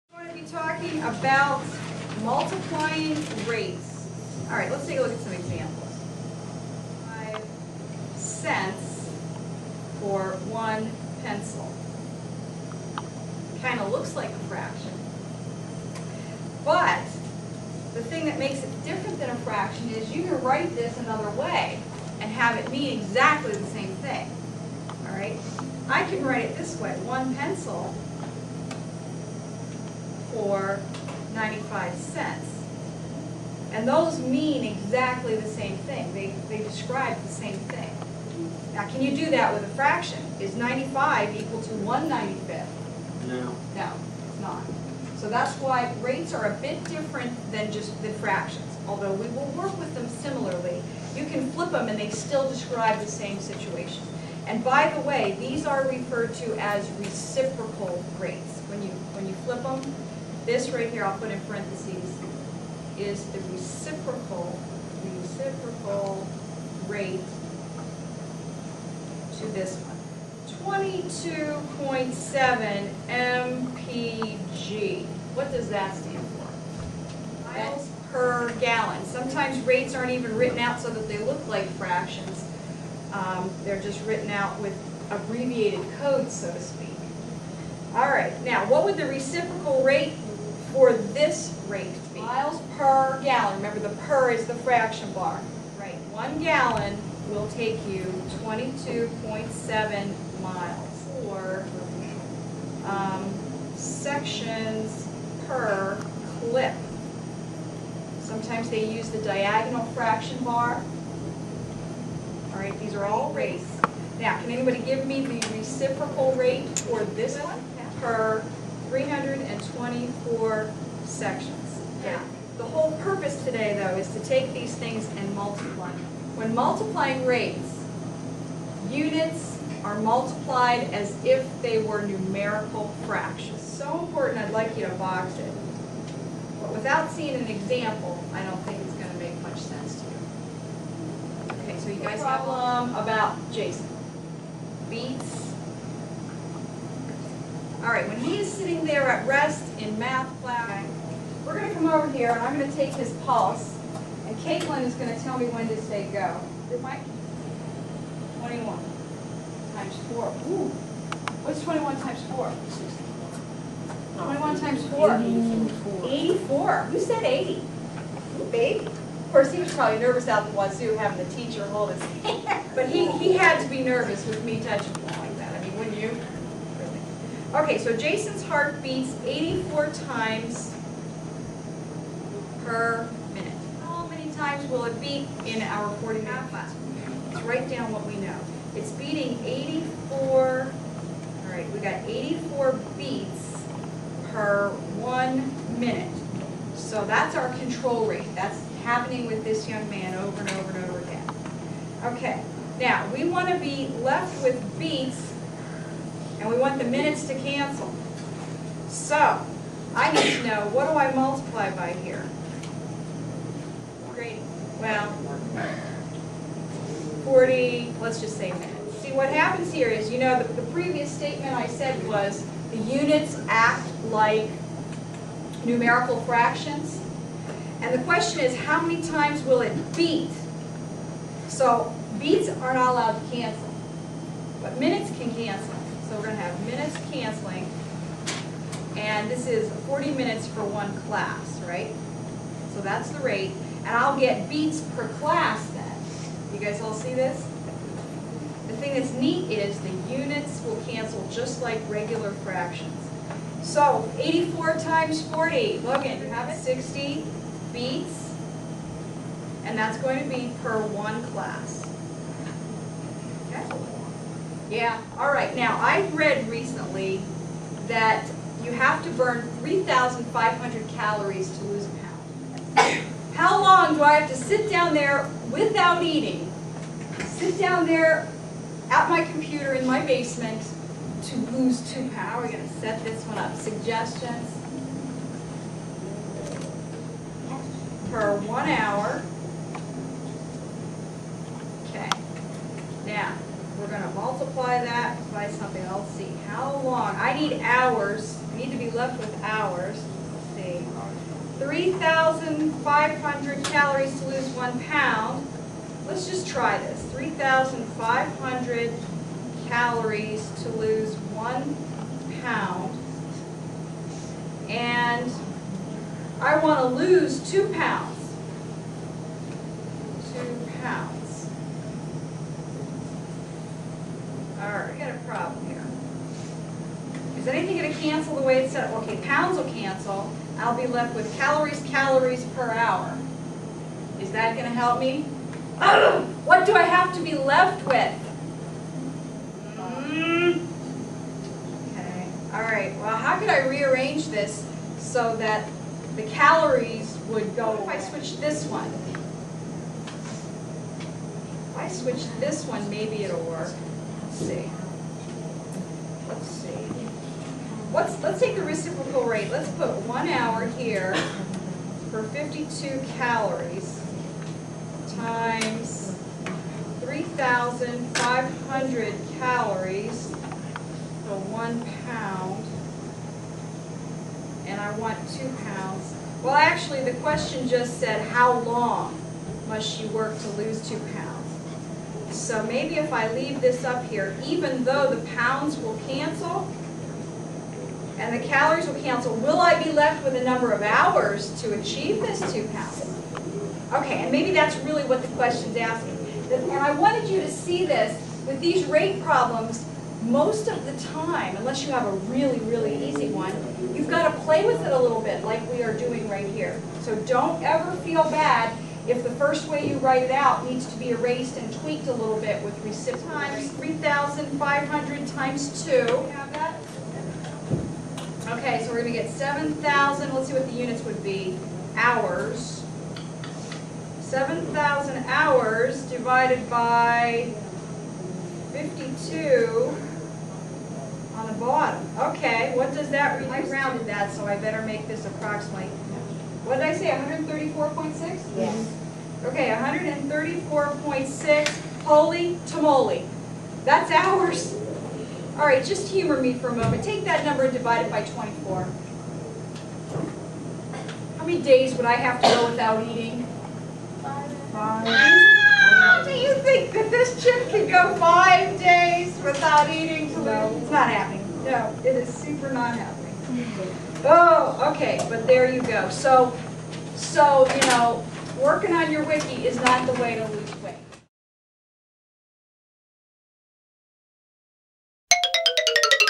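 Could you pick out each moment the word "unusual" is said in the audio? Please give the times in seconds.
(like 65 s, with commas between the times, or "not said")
not said.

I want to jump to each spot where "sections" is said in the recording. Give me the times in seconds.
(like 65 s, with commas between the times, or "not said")
103 s, 121 s.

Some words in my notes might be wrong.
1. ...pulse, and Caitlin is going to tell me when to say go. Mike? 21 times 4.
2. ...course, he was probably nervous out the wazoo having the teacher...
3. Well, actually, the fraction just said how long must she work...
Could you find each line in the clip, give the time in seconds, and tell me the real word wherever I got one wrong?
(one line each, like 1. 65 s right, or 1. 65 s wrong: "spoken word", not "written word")
1. 153 s right
2. 169 s right
3. 376 s wrong: "question", not "fraction".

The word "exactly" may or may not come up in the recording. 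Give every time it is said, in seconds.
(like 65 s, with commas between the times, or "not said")
22 s, 34 s.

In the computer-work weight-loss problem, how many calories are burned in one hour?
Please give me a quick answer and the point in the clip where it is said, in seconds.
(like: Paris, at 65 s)
52, at 362 s.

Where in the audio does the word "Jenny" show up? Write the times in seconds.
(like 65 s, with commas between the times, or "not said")
not said.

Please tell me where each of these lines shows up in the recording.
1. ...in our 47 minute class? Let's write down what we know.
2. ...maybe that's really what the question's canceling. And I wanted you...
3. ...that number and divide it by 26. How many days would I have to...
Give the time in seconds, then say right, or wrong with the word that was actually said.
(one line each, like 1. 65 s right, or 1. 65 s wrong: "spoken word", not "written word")
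1. 185 s wrong: "40", not "47"
2. 394 s wrong: "asking", not "canceling"
3. 447 s wrong: "24", not "26".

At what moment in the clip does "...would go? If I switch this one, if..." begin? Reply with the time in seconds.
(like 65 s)
347 s.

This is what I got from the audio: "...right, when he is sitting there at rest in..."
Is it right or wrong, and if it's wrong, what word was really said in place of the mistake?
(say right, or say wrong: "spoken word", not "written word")
right.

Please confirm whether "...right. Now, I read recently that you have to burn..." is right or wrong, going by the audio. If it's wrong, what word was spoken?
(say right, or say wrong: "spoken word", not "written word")
right.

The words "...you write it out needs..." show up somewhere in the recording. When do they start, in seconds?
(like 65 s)
409 s.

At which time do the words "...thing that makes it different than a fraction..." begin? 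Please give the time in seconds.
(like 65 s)
18 s.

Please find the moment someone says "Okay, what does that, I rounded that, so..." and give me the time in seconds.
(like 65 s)
432 s.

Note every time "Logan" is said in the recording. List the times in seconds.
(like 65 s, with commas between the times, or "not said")
255 s.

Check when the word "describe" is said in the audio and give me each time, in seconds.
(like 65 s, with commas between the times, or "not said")
36 s, 52 s.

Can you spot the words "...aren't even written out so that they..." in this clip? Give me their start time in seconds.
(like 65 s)
79 s.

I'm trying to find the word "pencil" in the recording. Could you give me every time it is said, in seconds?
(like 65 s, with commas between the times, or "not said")
11 s, 27 s.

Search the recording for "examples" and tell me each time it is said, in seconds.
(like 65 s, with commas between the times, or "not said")
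5 s, 137 s.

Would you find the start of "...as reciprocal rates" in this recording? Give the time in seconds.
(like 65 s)
56 s.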